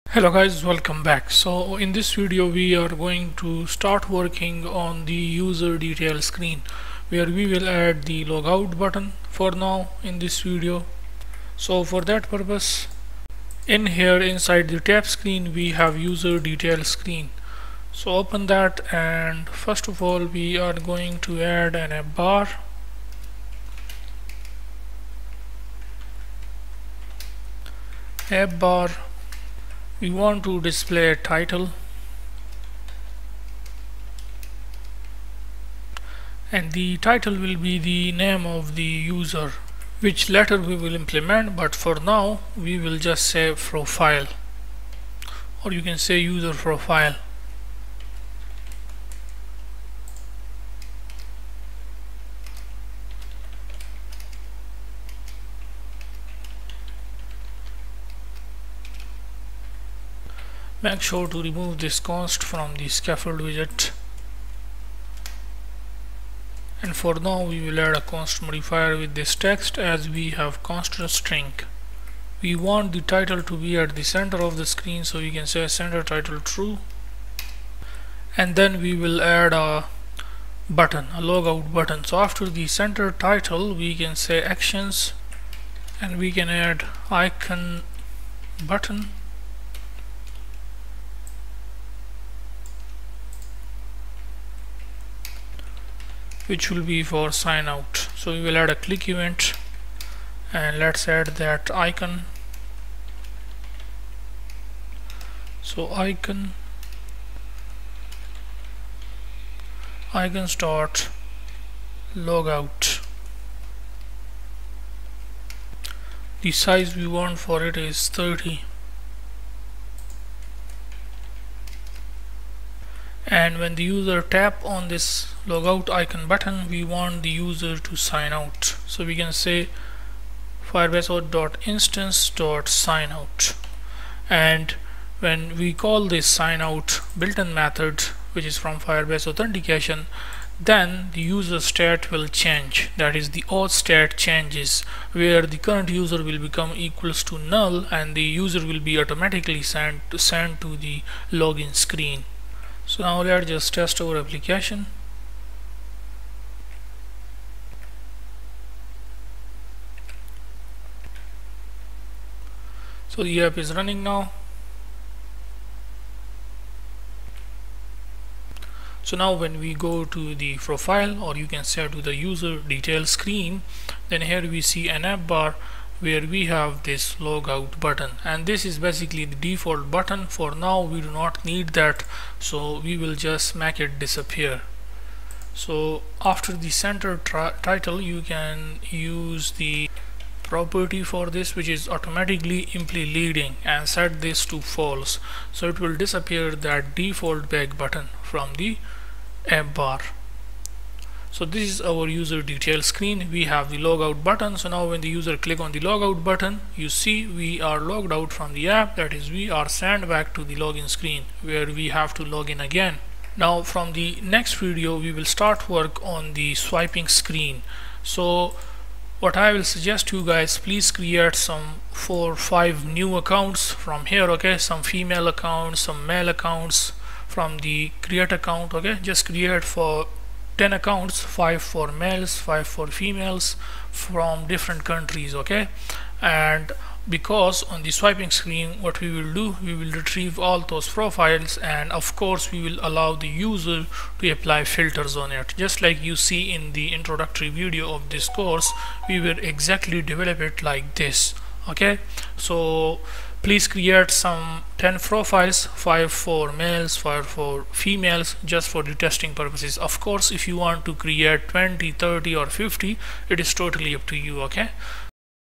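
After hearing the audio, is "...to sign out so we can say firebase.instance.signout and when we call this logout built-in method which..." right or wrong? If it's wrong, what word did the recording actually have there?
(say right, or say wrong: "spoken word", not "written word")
wrong: "signout", not "logout".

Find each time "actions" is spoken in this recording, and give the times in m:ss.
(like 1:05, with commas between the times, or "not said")
1:24.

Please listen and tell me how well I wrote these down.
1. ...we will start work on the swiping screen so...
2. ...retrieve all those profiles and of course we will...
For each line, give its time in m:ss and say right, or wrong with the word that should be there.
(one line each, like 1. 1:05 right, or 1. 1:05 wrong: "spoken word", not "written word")
1. 3:34 right
2. 3:59 right.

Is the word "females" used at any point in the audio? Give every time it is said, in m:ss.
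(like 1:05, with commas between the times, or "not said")
3:44, 3:52, 4:17.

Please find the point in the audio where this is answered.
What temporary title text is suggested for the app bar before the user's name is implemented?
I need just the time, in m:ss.
0:46.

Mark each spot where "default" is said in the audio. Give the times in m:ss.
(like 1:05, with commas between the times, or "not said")
2:59, 3:16.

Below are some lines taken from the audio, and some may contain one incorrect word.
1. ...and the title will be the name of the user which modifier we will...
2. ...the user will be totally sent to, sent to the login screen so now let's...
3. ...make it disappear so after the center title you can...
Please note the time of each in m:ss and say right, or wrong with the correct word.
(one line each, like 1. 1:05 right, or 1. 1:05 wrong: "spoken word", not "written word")
1. 0:36 wrong: "later", not "modifier"
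2. 2:28 wrong: "automatically", not "totally"
3. 3:03 right.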